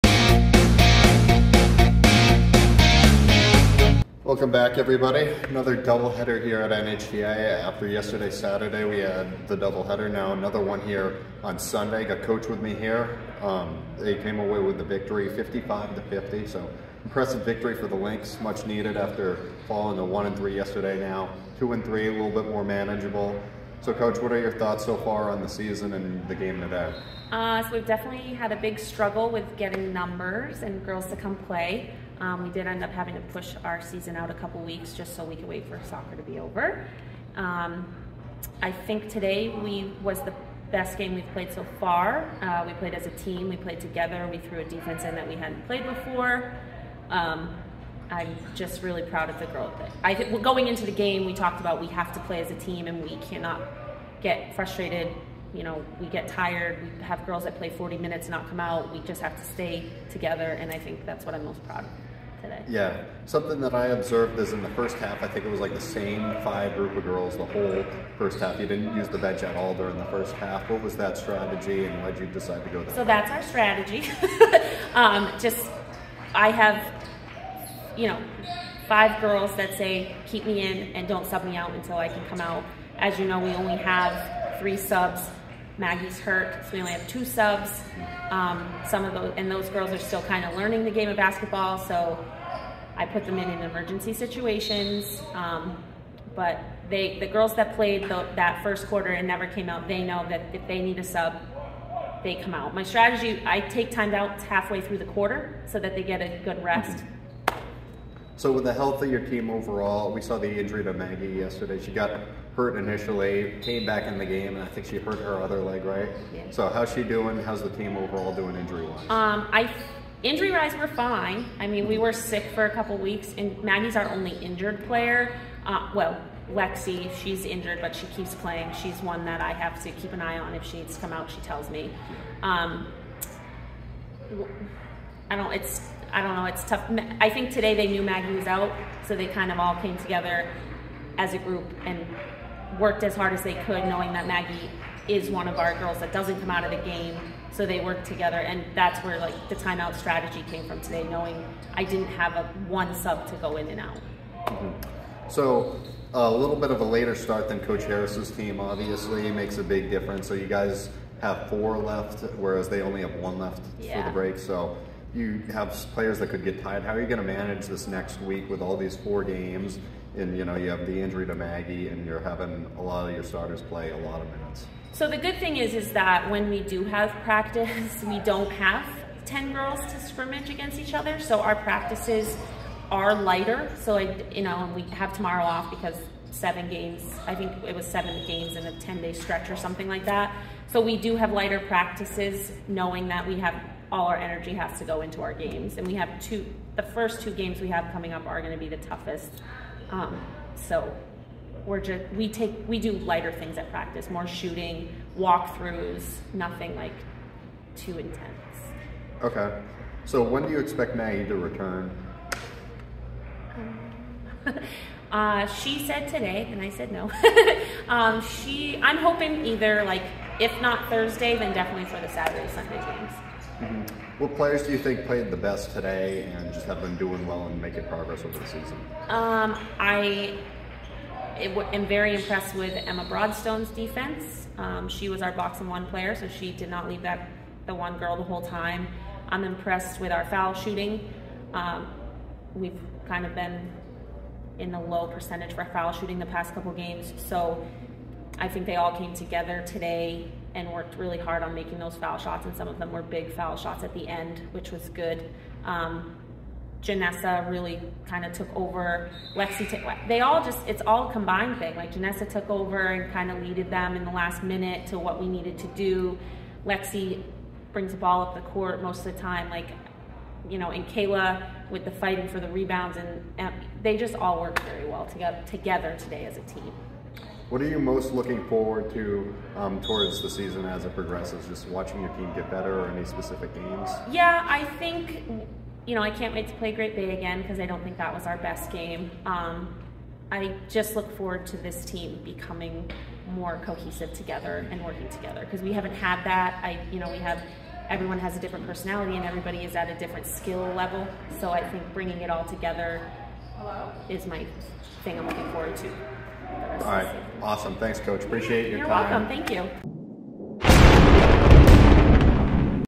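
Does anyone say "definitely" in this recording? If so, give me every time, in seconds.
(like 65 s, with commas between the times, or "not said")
27 s, 221 s.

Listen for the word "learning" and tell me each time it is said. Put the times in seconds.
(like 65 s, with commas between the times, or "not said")
90 s.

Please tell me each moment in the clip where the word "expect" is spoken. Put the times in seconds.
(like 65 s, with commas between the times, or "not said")
210 s.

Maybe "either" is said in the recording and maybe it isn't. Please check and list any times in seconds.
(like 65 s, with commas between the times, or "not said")
219 s.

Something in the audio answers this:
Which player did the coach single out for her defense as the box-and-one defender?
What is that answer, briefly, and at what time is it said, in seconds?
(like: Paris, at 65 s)
Emma Broadstone, at 232 s.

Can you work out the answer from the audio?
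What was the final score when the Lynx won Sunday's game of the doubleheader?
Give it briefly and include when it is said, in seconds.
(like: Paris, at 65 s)
55 to 50, at 15 s.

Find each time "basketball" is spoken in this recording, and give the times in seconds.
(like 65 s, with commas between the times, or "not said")
91 s.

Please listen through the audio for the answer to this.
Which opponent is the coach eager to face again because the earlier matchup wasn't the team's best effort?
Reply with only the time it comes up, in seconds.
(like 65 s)
286 s.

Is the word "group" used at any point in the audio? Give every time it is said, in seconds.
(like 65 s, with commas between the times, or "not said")
66 s, 141 s.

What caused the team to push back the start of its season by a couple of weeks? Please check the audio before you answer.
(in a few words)
Soccer.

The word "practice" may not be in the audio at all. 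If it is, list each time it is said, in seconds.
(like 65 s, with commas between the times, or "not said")
177 s, 181 s, 191 s, 203 s.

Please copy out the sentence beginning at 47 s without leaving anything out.
Um, I'm just really proud of the growth.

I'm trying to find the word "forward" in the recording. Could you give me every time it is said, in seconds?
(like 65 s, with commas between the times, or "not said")
278 s, 291 s, 305 s.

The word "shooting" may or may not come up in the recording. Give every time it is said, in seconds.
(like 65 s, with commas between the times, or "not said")
204 s, 240 s, 245 s.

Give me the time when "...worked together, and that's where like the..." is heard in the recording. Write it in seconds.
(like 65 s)
147 s.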